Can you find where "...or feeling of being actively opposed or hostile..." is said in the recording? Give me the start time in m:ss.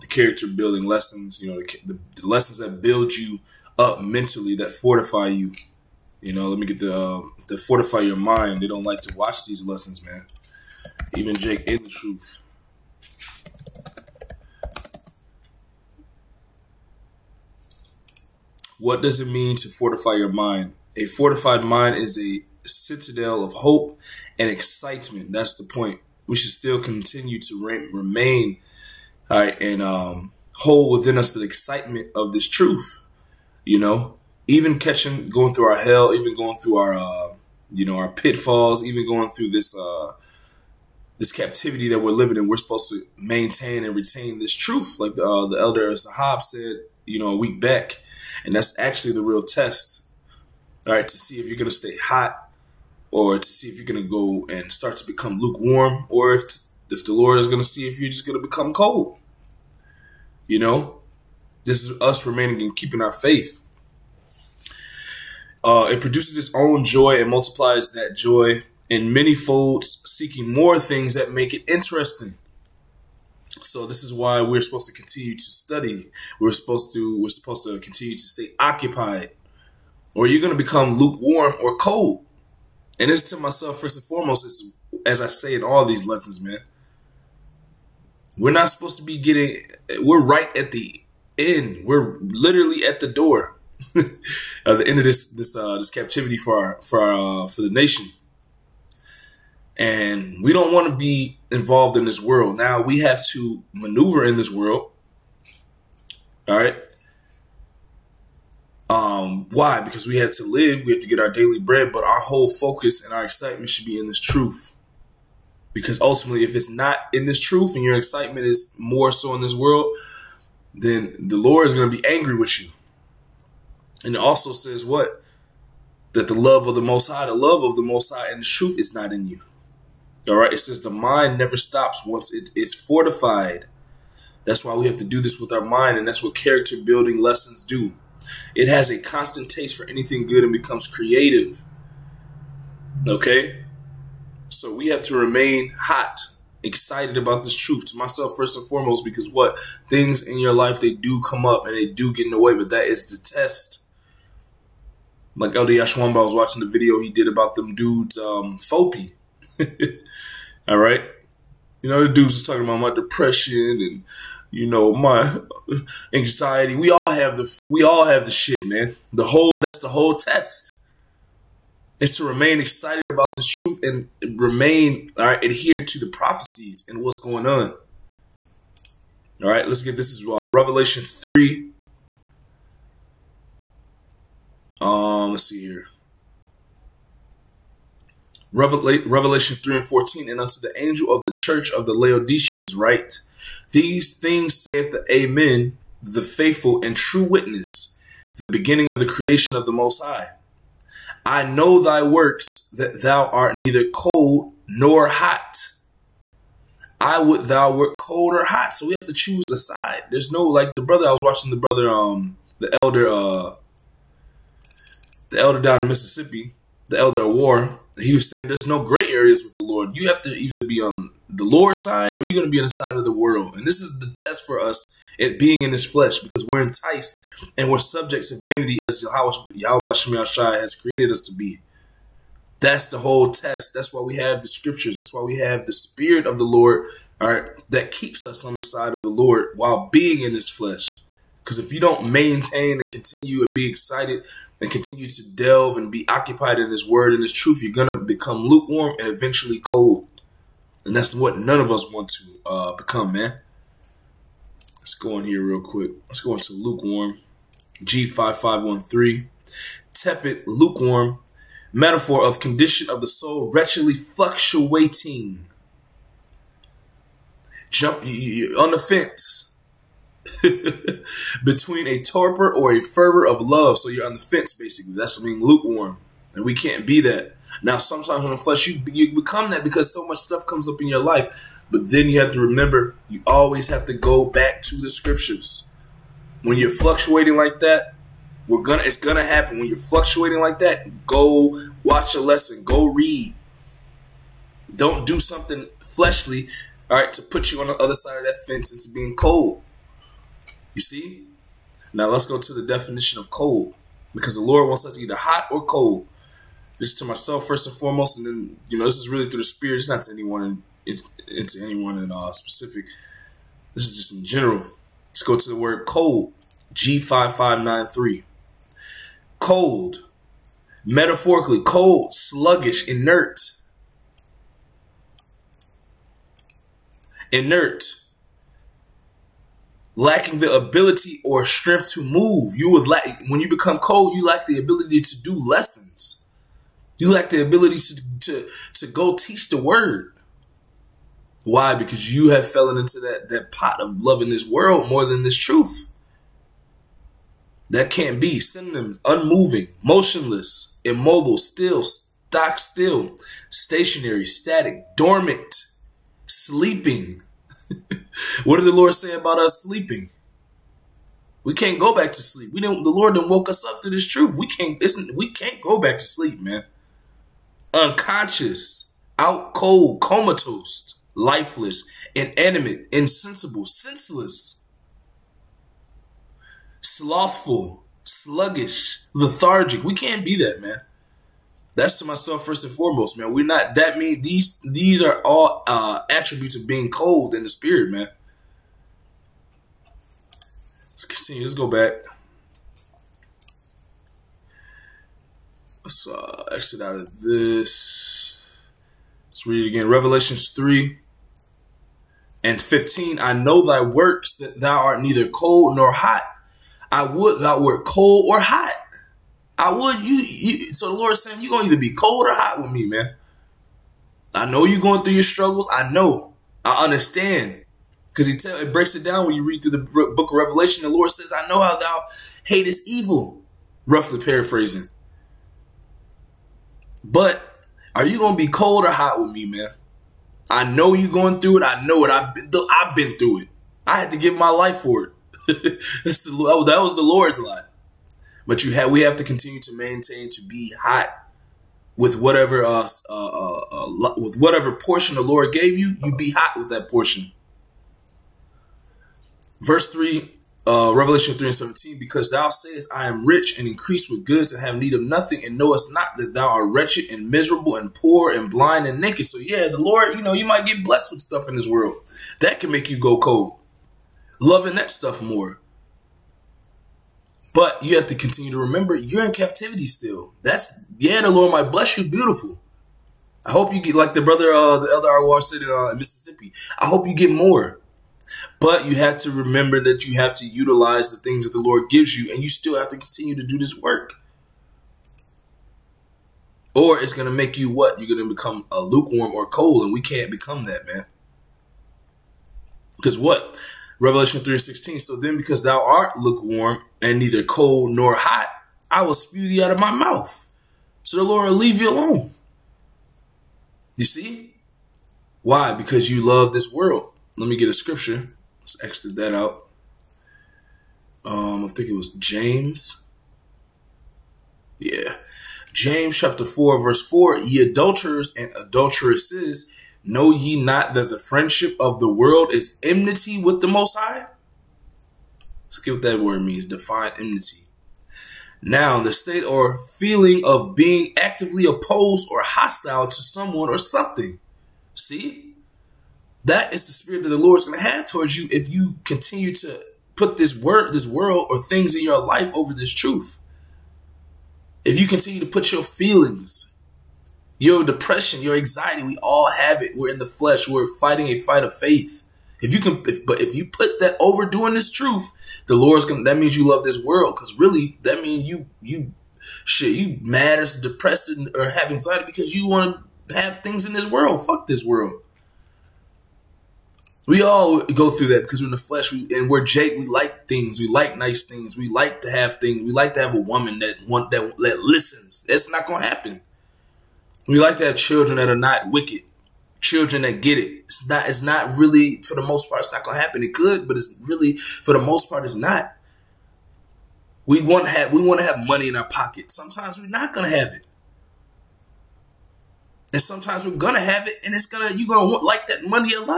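8:49.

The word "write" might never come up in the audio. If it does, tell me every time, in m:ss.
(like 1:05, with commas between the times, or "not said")
3:12.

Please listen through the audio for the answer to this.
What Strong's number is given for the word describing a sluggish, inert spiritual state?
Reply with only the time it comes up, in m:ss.
5:16.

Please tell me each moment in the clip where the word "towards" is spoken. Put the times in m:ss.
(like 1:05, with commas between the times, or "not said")
8:58.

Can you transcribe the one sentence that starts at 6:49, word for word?
I would you, you so the Lord's saying you're gonna either be cold or hot with me, man.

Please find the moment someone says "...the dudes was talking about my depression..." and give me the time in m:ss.
2:42.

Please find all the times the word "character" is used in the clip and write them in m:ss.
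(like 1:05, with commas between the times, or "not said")
0:00, 2:16.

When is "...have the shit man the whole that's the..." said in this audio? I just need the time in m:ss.
2:48.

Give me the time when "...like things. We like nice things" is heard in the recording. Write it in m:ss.
9:30.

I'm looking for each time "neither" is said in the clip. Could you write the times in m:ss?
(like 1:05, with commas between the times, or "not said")
3:23, 6:45, 8:17.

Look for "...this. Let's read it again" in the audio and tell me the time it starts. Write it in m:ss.
6:37.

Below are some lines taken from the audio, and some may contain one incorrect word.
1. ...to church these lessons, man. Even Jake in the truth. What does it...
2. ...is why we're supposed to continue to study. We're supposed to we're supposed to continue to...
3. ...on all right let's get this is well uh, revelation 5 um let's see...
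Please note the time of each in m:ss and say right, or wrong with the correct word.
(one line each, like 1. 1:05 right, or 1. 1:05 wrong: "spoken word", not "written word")
1. 0:09 wrong: "watch", not "church"
2. 1:14 right
3. 2:57 wrong: "3", not "5".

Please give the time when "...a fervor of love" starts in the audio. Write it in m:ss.
4:32.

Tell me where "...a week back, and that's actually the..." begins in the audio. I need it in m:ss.
0:47.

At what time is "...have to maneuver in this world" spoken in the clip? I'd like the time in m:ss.
1:42.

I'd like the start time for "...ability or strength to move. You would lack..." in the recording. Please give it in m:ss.
5:30.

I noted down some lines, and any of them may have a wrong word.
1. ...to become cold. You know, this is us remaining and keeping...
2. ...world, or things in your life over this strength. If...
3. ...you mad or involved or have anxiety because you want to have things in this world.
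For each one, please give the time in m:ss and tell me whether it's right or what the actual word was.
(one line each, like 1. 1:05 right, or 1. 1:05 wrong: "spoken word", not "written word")
1. 0:58 right
2. 9:01 wrong: "truth", not "strength"
3. 9:19 wrong: "depressed", not "involved".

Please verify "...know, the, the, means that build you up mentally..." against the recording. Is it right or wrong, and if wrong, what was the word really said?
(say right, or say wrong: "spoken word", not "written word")
wrong: "lessons", not "means".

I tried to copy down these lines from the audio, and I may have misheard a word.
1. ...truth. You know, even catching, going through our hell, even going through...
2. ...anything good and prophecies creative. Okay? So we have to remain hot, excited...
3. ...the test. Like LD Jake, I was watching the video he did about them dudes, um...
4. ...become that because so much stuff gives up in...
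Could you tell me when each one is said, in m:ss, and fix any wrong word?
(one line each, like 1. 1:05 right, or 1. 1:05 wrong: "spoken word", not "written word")
1. 0:32 right
2. 2:19 wrong: "becomes", not "prophecies"
3. 2:33 wrong: "Ashwamba", not "Jake"
4. 4:39 wrong: "comes", not "gives".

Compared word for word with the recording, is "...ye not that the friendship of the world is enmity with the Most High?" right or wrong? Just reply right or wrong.
right.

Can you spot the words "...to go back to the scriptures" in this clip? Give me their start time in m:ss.
4:43.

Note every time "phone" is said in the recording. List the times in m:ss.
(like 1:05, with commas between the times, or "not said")
not said.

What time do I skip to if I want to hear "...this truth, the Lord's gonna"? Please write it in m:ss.
9:14.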